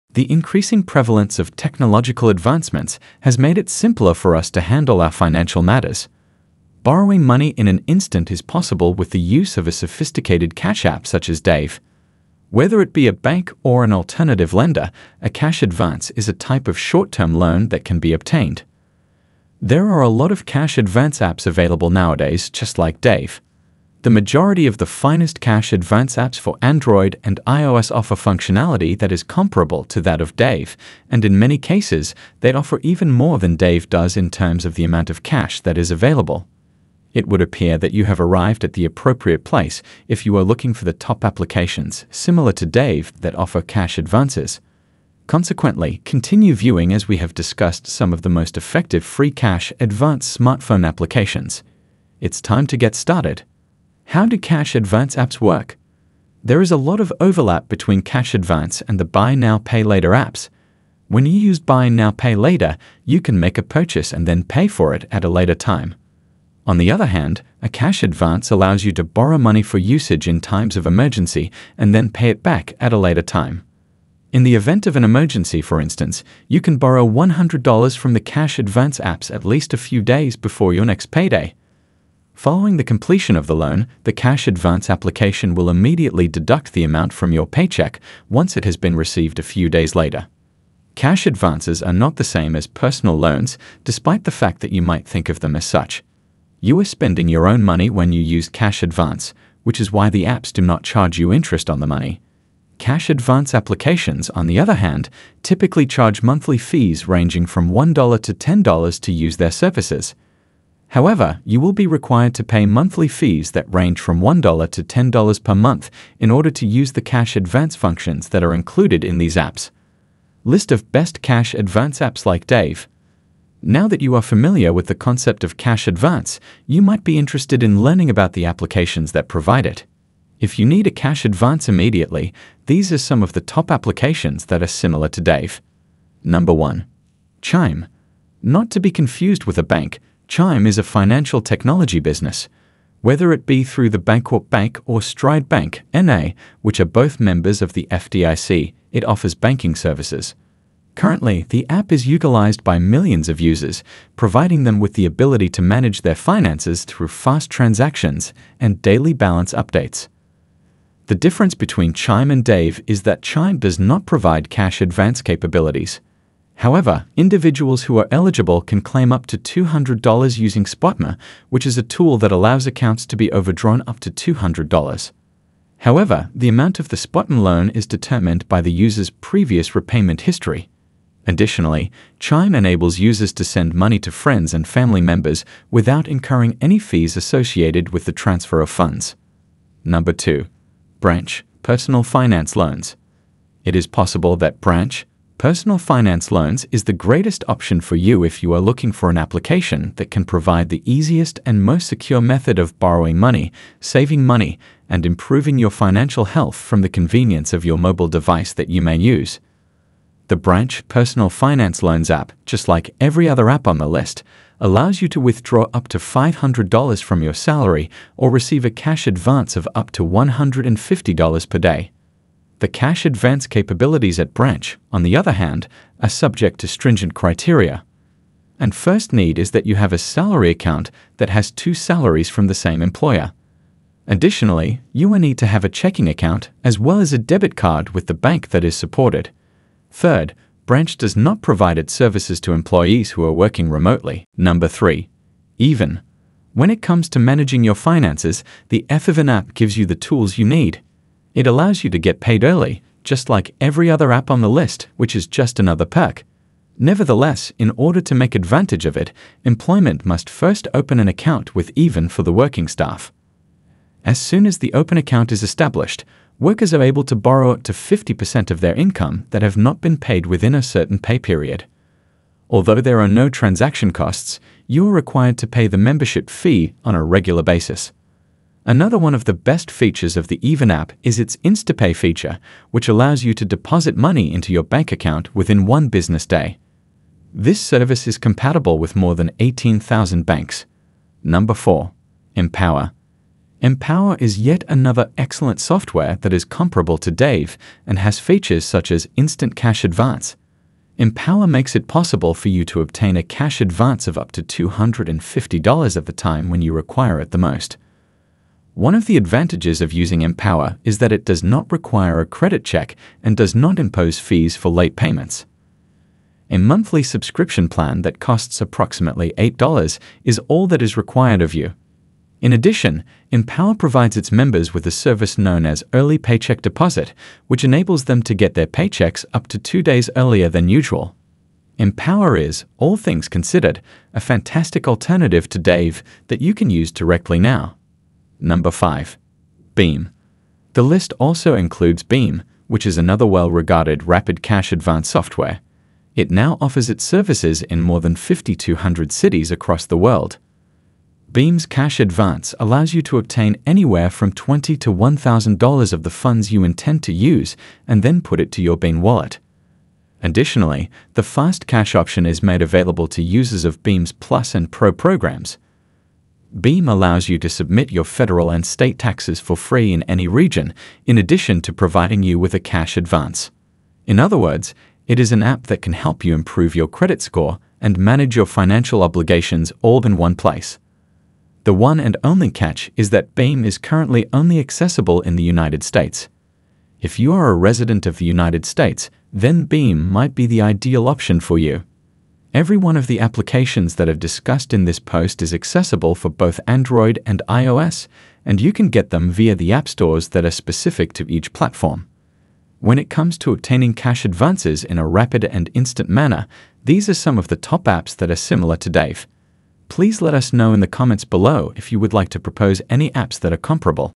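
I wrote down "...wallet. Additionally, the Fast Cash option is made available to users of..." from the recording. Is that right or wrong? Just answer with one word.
right.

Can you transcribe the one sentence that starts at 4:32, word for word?
Although there are no transaction costs, you are required to pay the membership fee on a regular basis.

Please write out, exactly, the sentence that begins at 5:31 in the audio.
Empower is, all things considered, a fantastic alternative to Dave that you can use directly now.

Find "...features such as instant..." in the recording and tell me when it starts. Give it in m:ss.
4:58.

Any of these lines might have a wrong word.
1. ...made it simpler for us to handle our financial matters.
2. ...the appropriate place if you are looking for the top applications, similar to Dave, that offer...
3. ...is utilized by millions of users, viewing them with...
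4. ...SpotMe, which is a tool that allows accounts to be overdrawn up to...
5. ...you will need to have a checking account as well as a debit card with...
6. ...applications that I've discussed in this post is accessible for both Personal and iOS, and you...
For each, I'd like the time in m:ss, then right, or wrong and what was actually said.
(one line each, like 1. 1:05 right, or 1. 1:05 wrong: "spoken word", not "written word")
1. 0:03 right
2. 0:38 right
3. 2:31 wrong: "providing", not "viewing"
4. 2:50 right
5. 3:54 right
6. 6:33 wrong: "Android", not "Personal".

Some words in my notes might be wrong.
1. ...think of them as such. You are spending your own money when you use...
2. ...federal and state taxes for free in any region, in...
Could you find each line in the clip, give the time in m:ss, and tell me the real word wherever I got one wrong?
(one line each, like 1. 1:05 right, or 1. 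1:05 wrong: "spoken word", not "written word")
1. 1:35 right
2. 6:08 right.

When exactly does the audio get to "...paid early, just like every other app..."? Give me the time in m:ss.
4:12.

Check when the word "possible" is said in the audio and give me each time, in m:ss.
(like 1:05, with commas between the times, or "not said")
0:08, 3:13, 5:01.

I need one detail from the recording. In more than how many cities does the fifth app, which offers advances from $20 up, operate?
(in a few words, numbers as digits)
5,200.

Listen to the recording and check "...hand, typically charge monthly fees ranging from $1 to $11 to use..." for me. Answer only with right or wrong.
wrong.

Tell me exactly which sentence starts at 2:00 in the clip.
List of best cash advance apps like Dave.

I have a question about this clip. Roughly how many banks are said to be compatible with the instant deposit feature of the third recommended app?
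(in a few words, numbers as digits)
18,000.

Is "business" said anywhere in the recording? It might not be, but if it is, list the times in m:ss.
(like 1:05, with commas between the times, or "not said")
2:21, 4:45.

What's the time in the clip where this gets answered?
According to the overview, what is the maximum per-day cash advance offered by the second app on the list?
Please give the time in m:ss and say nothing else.
3:40.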